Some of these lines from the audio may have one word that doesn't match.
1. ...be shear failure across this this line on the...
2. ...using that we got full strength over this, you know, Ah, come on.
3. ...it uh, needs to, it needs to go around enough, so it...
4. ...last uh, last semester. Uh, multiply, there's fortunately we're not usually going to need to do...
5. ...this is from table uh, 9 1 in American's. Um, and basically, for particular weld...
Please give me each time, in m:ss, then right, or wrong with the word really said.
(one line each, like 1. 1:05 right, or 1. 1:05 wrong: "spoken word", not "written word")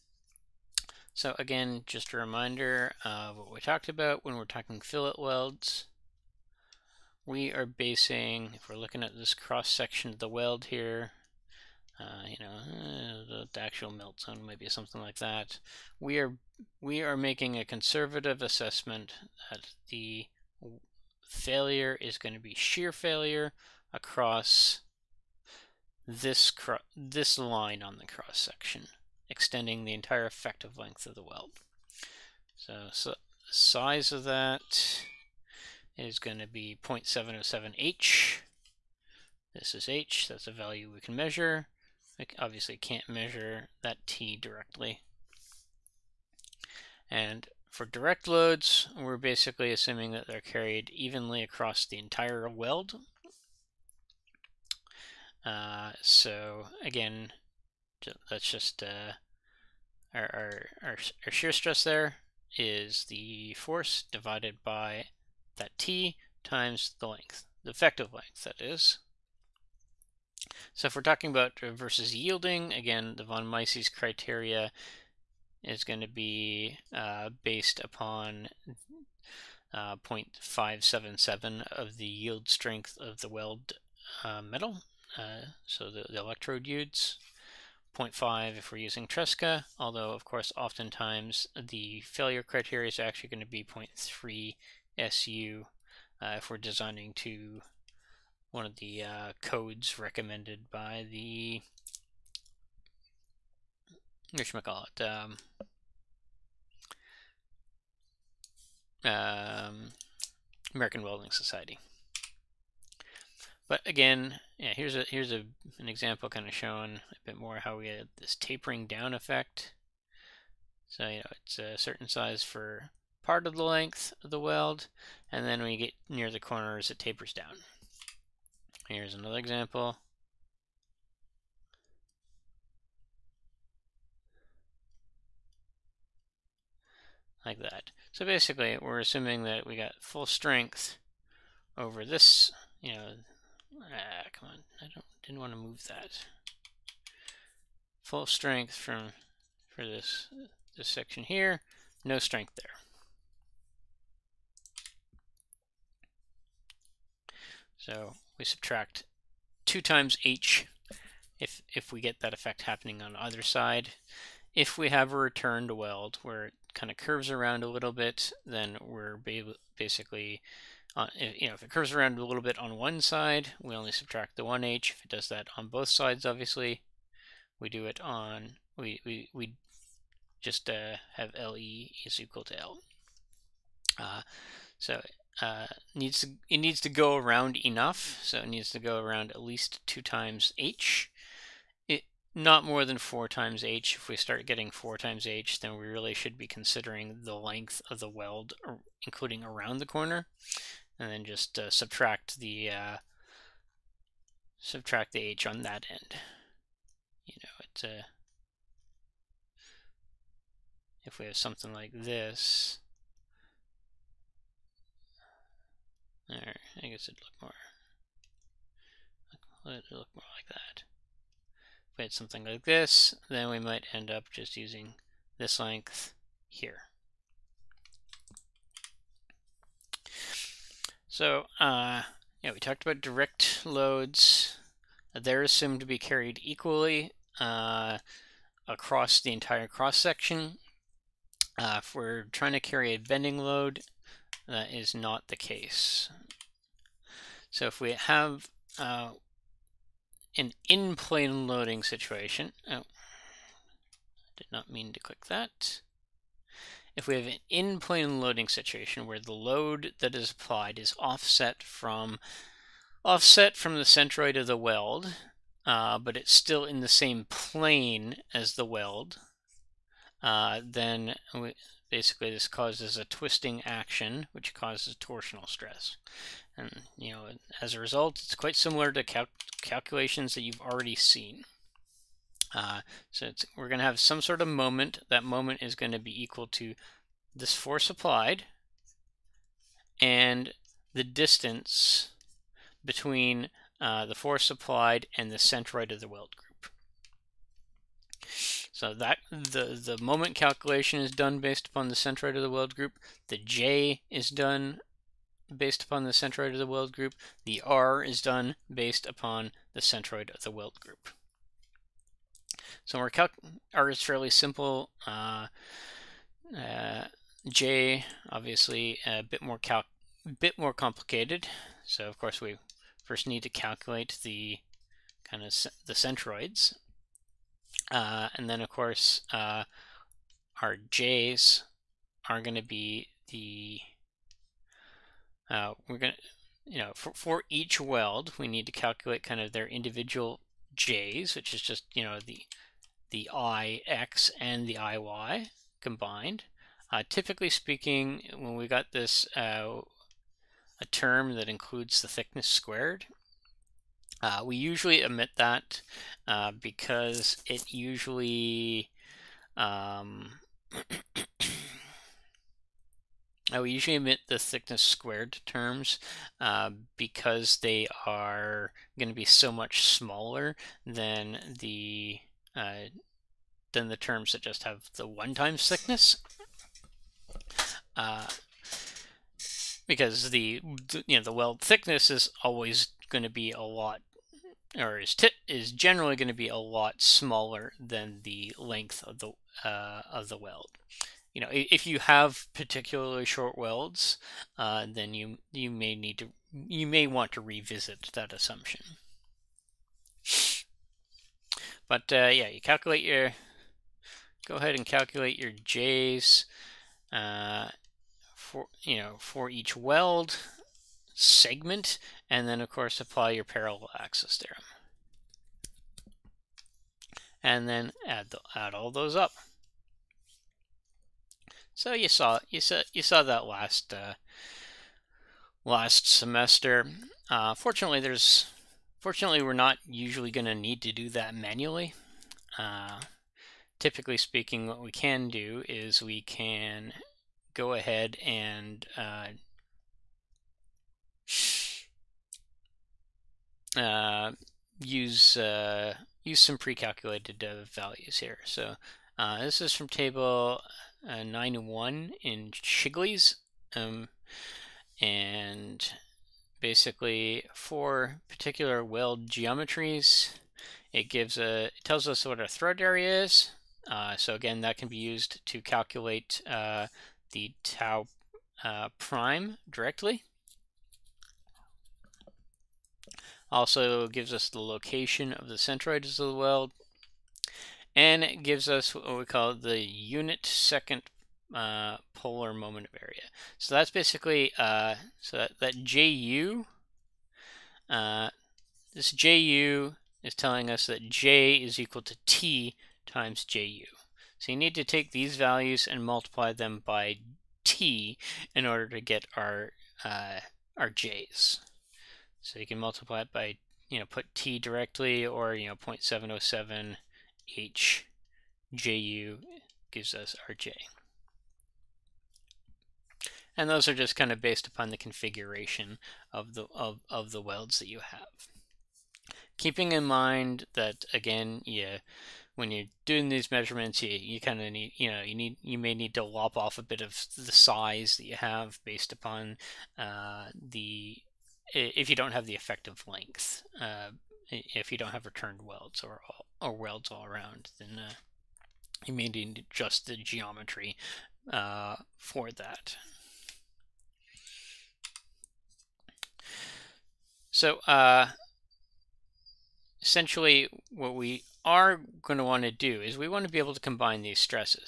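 1. 0:22 right
2. 2:19 wrong: "assuming", not "using"
3. 3:04 right
4. 7:03 wrong: "fortunately", not "multiply"
5. 7:29 wrong: "Shigley", not "American".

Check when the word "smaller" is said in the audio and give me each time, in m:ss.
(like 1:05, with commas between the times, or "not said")
6:09, 6:27.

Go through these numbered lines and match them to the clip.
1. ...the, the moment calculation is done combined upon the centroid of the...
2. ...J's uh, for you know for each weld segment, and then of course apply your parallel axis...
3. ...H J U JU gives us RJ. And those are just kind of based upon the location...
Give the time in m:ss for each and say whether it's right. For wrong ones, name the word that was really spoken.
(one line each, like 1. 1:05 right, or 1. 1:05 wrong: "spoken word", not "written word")
1. 4:59 wrong: "based", not "combined"
2. 6:45 right
3. 8:27 wrong: "configuration", not "location".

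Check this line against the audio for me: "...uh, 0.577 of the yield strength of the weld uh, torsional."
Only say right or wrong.
wrong.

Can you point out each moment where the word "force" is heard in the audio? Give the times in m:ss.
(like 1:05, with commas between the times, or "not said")
1:03, 4:47, 4:54.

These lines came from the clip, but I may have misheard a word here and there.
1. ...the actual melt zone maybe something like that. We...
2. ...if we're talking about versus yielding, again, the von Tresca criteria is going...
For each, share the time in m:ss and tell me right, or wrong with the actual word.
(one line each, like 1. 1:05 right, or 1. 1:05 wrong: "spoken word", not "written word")
1. 0:13 right
2. 1:10 wrong: "Mises", not "Tresca".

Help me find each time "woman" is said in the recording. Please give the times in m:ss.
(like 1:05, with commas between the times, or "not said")
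not said.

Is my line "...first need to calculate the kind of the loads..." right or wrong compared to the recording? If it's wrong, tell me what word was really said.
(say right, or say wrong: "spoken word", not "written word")
wrong: "centroids", not "loads".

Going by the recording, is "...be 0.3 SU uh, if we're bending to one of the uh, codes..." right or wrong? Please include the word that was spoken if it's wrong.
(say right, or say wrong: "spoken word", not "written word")
wrong: "designing", not "bending".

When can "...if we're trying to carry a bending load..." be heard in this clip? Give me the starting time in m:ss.
4:01.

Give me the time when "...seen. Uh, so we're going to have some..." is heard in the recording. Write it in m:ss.
4:40.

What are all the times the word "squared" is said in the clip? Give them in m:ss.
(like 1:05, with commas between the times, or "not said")
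5:52, 6:04.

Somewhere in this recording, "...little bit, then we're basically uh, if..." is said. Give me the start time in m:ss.
2:47.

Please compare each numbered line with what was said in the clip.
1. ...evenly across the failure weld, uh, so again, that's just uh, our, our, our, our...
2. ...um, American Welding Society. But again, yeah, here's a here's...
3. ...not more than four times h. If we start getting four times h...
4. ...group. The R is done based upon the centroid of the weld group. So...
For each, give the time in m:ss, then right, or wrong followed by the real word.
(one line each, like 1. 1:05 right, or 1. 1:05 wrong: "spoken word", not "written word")
1. 0:50 wrong: "entire", not "failure"
2. 1:49 right
3. 3:12 right
4. 5:06 right.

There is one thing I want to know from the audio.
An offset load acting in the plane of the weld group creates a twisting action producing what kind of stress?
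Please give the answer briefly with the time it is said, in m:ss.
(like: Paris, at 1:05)
torsional stress, at 4:34.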